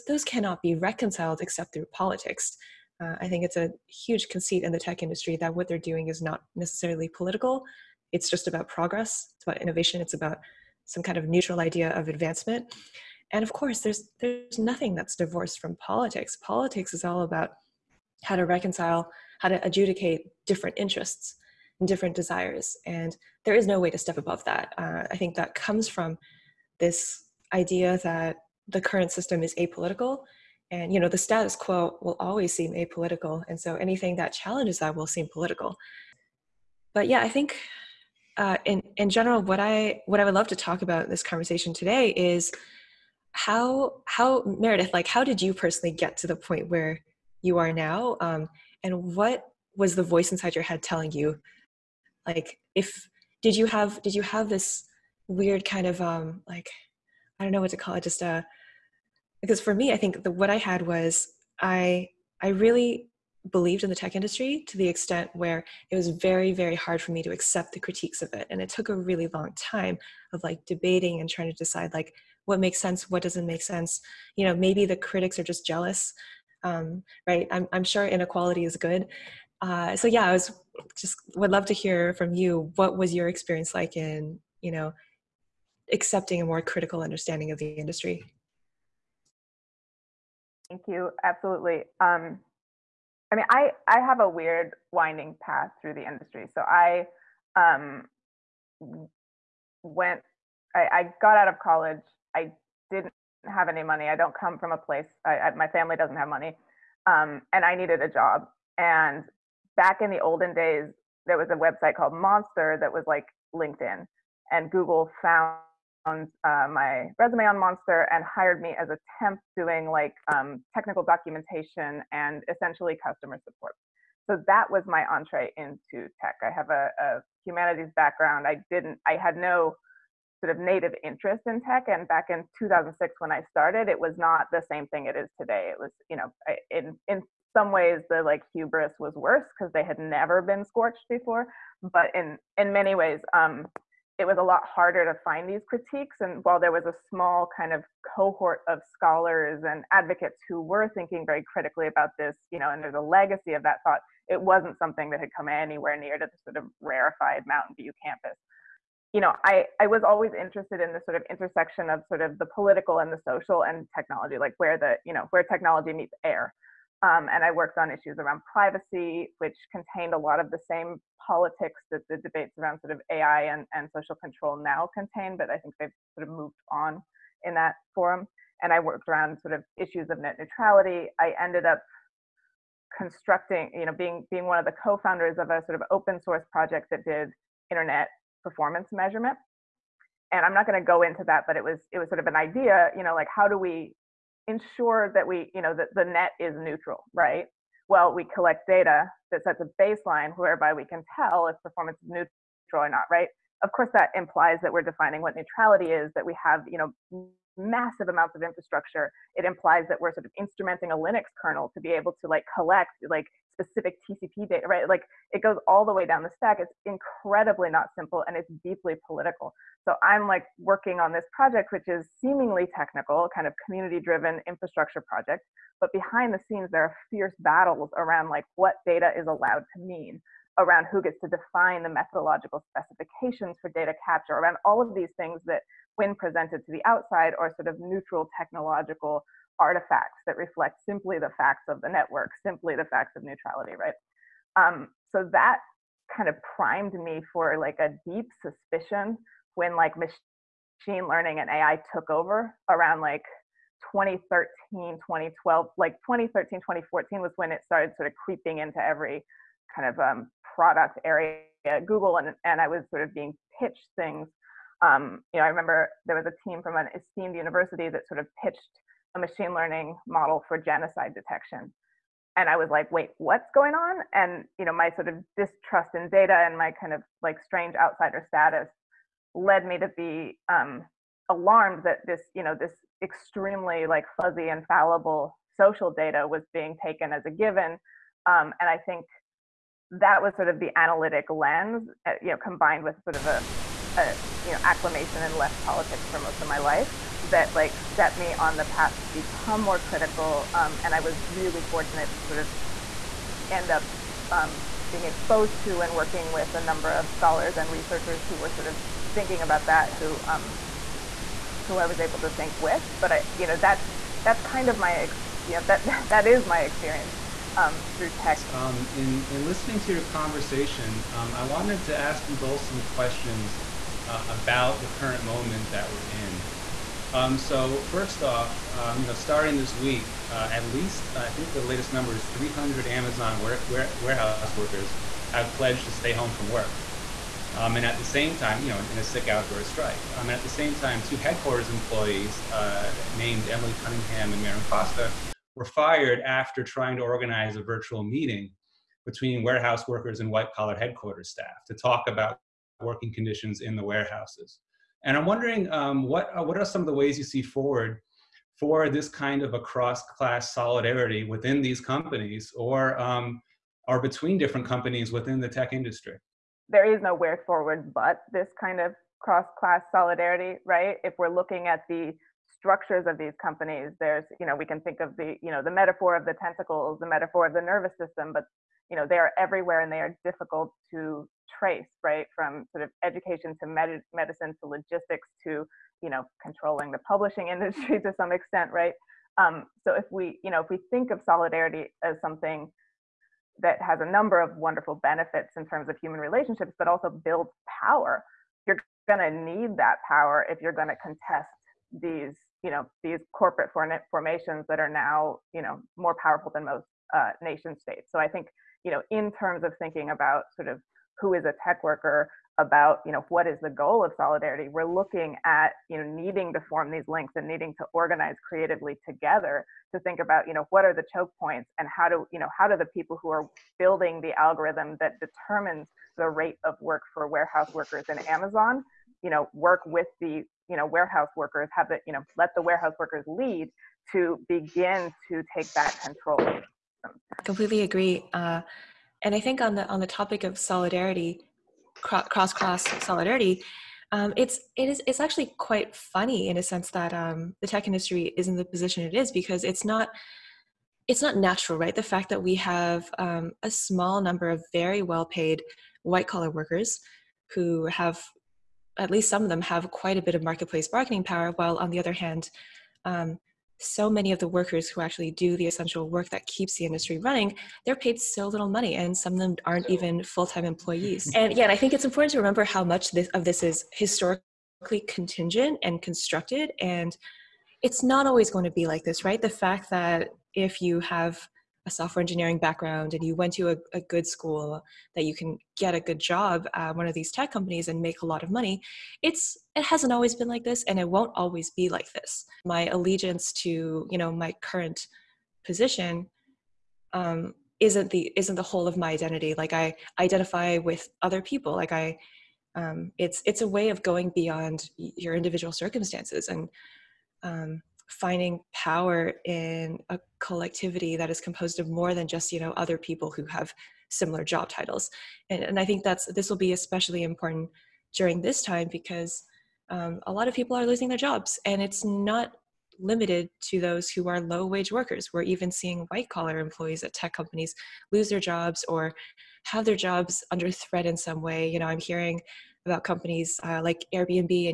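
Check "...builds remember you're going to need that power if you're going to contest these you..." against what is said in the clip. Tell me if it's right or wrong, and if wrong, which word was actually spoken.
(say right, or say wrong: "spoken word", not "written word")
wrong: "power", not "remember".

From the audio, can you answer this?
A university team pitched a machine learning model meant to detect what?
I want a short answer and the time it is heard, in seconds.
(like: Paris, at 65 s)
genocide, at 270 s.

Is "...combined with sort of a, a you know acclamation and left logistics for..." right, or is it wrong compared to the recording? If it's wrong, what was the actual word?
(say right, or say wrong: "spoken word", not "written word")
wrong: "politics", not "logistics".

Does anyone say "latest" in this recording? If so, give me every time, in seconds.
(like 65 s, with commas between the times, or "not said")
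331 s.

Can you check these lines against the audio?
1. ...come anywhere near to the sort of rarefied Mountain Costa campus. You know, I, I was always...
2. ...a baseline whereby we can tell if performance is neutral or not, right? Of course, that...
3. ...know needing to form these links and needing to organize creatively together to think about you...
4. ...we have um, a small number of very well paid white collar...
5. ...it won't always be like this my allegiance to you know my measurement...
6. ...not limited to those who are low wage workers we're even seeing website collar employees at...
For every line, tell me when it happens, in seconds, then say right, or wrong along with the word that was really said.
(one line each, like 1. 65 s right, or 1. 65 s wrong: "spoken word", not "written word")
1. 155 s wrong: "View", not "Costa"
2. 199 s right
3. 415 s right
4. 452 s right
5. 490 s wrong: "current", not "measurement"
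6. 522 s wrong: "white", not "website".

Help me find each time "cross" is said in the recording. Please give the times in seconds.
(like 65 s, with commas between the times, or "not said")
359 s, 369 s, 442 s.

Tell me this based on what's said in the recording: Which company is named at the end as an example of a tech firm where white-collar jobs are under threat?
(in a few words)
Airbnb.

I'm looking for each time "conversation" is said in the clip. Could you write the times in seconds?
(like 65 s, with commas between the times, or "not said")
41 s, 320 s.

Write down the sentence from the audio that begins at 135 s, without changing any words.
It was, you know, I, in, in some ways the like hubris was worse because they had never been scorched before.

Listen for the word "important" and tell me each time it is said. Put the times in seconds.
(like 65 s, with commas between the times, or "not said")
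472 s, 517 s.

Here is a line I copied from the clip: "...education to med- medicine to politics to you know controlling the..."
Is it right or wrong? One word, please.
wrong.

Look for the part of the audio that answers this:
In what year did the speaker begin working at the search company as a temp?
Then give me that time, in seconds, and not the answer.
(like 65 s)
132 s.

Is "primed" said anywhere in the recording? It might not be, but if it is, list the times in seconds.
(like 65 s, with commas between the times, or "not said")
246 s.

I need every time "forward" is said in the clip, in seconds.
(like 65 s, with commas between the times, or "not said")
357 s, 367 s.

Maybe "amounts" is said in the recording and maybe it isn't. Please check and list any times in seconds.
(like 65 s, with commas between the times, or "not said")
208 s.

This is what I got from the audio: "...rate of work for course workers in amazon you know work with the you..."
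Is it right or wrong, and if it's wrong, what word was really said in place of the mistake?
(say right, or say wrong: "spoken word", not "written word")
wrong: "warehouse", not "course".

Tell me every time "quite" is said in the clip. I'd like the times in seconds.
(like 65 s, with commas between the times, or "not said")
445 s, 459 s.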